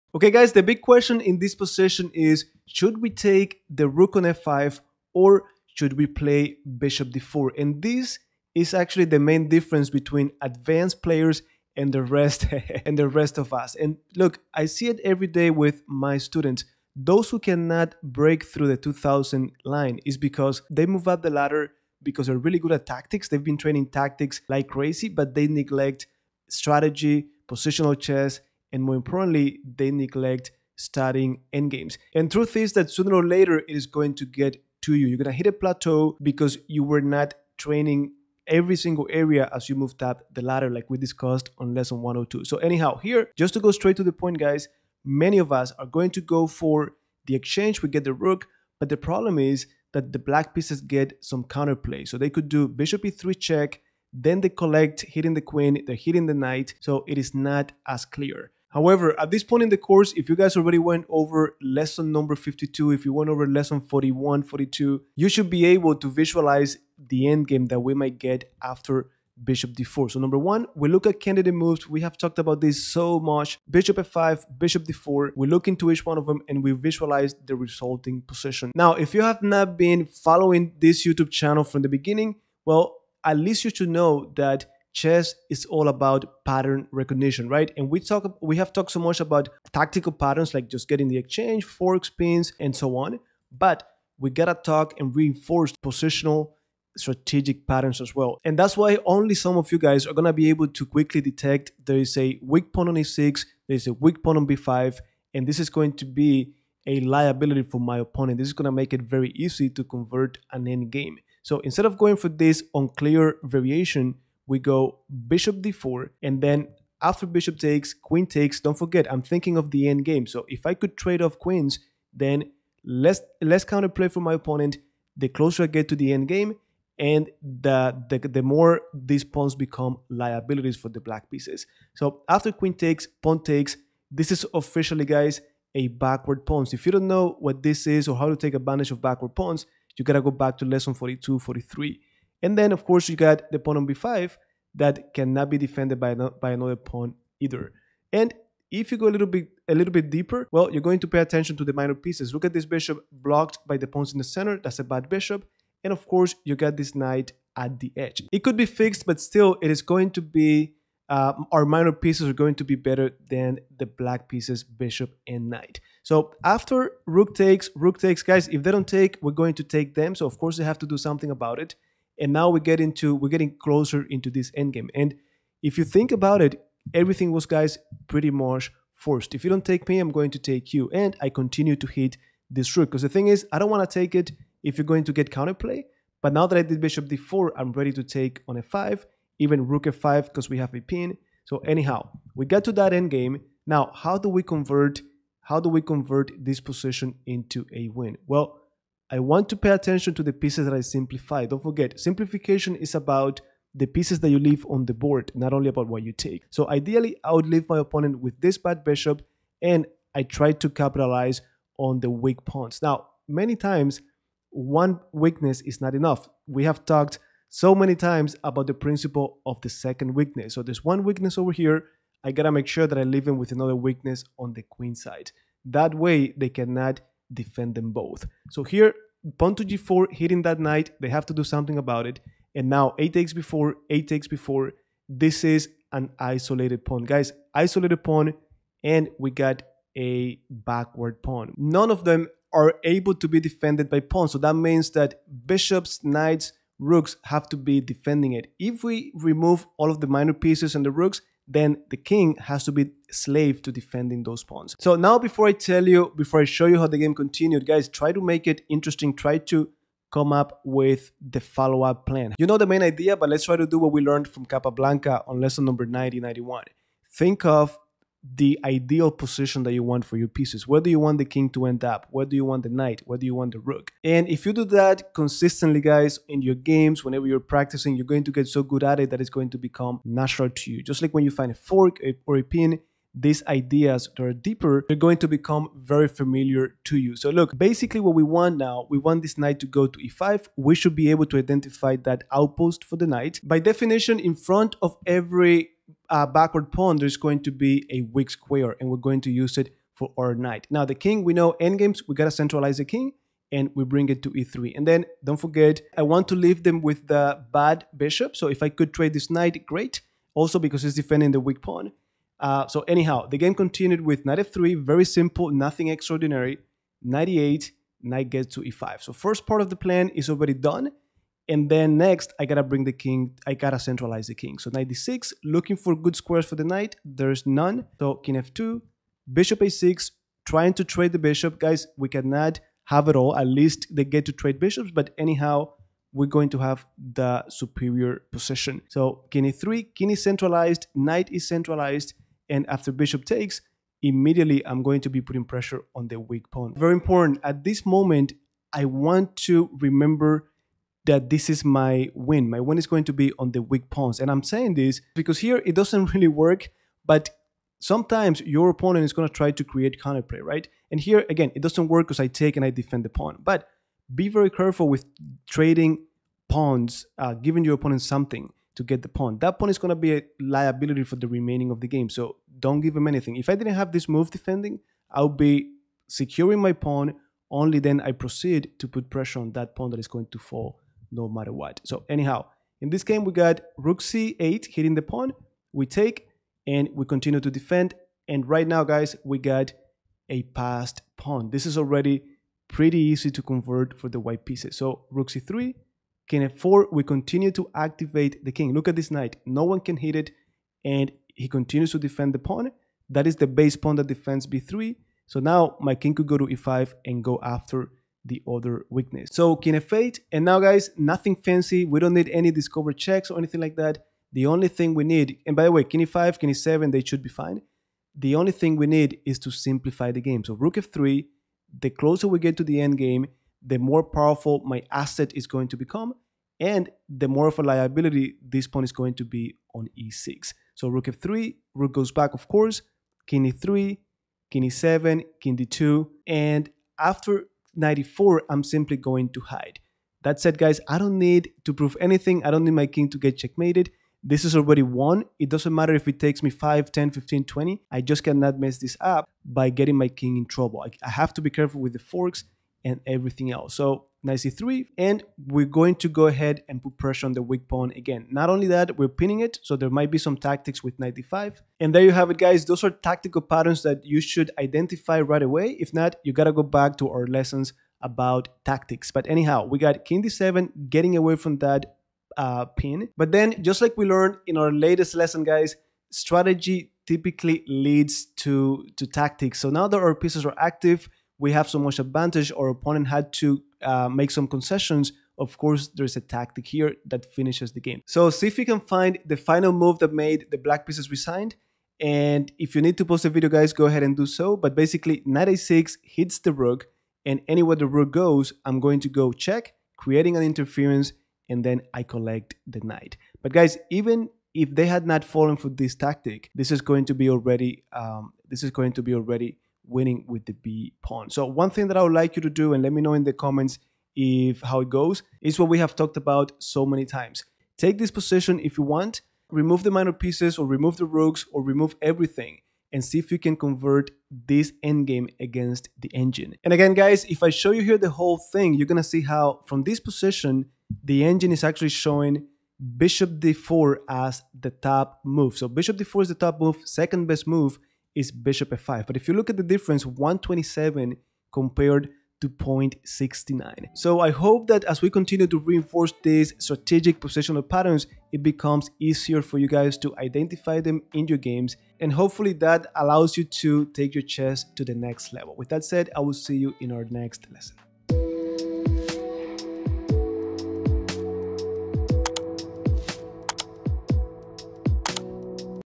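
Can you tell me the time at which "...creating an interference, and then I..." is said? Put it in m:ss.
8:19.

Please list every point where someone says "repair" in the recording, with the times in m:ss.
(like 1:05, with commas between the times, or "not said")
not said.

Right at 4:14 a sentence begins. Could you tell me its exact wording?
So now before I tell you, before I show you how the game continued, guys, try to make it interesting.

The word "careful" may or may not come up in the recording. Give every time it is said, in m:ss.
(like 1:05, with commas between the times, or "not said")
6:04, 7:31.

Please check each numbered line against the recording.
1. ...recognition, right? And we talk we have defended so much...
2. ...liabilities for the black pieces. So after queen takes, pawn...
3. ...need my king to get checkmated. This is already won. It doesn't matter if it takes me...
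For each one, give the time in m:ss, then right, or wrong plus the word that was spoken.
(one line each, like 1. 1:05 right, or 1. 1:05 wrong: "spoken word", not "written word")
1. 1:26 wrong: "talked", not "defended"
2. 2:10 right
3. 7:22 right.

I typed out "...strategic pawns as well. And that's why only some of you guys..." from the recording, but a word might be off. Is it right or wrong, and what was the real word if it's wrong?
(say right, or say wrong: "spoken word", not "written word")
wrong: "patterns", not "pawns".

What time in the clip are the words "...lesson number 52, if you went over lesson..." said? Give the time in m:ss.
1:01.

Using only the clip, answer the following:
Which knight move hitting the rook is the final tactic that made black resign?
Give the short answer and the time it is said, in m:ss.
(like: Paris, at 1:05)
Knight a6, at 8:15.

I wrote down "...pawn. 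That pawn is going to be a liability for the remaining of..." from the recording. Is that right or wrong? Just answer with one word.
right.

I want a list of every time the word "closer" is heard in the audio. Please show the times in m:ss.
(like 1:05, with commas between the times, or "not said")
2:05, 2:53, 7:01.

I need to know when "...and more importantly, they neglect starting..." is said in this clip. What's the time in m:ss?
0:28.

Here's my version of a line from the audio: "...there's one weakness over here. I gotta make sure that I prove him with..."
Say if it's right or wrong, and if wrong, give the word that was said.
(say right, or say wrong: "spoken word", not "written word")
wrong: "leave", not "prove".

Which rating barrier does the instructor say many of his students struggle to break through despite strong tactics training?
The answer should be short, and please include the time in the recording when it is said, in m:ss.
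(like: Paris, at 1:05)
2000, at 0:18.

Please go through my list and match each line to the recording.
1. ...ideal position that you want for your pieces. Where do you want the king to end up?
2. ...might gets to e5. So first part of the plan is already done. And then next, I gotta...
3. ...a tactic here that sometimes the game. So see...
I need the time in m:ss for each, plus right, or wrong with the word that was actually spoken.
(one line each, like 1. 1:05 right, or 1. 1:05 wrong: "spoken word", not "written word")
1. 4:28 right
2. 5:18 wrong: "knight", not "might"
3. 8:06 wrong: "finishes", not "sometimes".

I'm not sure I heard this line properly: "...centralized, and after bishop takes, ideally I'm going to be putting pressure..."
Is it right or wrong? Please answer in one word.
wrong.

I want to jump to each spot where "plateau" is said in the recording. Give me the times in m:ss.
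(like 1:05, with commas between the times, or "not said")
0:35.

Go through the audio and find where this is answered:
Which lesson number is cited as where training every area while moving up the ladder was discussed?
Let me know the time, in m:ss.
0:41.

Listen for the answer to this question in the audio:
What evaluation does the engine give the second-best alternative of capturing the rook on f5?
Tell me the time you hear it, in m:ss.
9:02.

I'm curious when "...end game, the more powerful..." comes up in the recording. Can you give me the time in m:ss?
7:02.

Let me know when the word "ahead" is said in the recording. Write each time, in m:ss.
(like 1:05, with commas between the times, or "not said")
7:36, 8:13.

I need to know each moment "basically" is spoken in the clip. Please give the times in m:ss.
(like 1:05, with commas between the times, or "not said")
4:47, 8:14.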